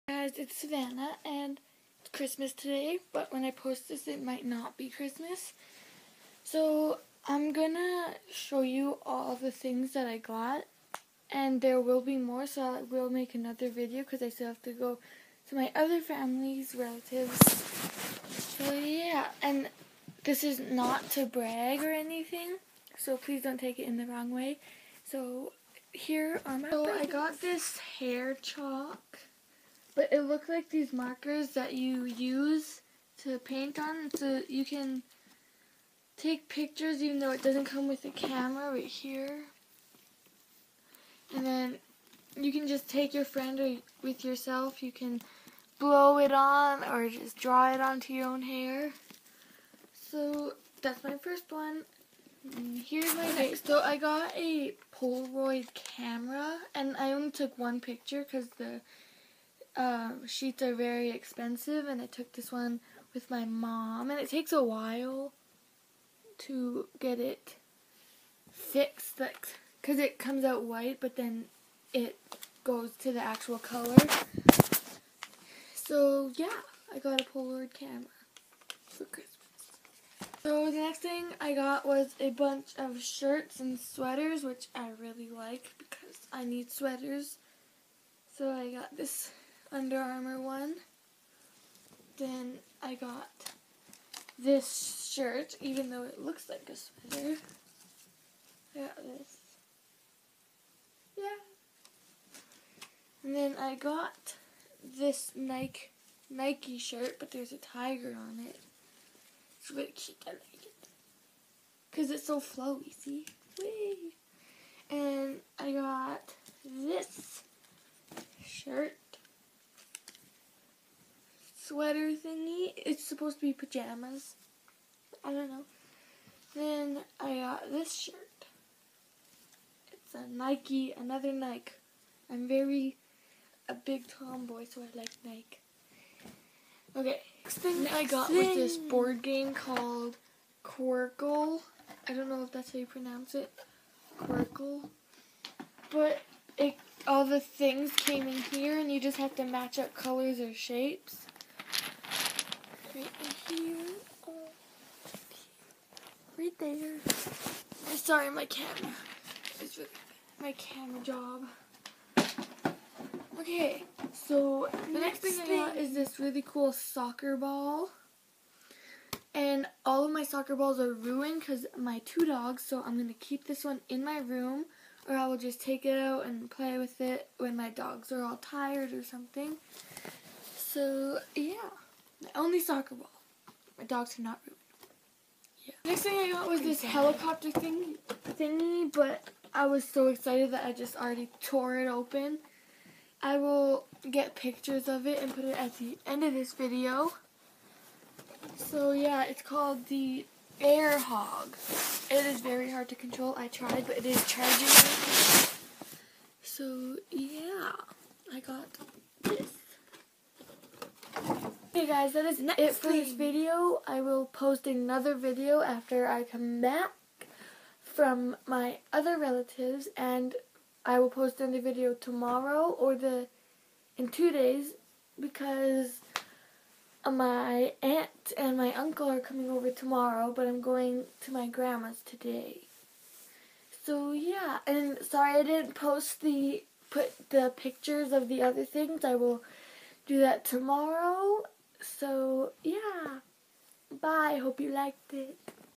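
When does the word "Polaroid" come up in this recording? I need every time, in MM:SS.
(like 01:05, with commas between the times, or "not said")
00:54, 01:17.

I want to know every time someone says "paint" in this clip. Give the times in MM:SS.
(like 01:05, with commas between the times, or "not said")
00:33.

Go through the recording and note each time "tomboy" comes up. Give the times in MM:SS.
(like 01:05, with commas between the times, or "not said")
02:14.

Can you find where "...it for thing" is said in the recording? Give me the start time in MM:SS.
03:32.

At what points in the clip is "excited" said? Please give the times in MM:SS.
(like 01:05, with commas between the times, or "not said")
03:10.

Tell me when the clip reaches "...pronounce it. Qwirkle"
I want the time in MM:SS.
02:22.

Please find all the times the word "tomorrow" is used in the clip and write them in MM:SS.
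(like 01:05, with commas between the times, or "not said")
03:41, 03:49, 04:00.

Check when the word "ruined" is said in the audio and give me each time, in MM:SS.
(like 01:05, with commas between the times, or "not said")
02:50, 03:04.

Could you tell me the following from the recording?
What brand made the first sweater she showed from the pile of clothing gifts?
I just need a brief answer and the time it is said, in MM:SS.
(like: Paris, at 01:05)
Under Armour, at 01:29.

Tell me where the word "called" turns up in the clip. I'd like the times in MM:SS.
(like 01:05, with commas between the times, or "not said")
02:19, 03:19.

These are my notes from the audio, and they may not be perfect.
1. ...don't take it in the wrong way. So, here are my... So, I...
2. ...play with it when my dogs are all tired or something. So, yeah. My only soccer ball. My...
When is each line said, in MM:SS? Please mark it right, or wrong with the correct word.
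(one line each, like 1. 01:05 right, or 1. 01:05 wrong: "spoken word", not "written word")
1. 00:23 right
2. 02:56 right.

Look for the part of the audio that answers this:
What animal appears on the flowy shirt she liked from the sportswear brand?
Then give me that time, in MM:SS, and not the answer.
01:47.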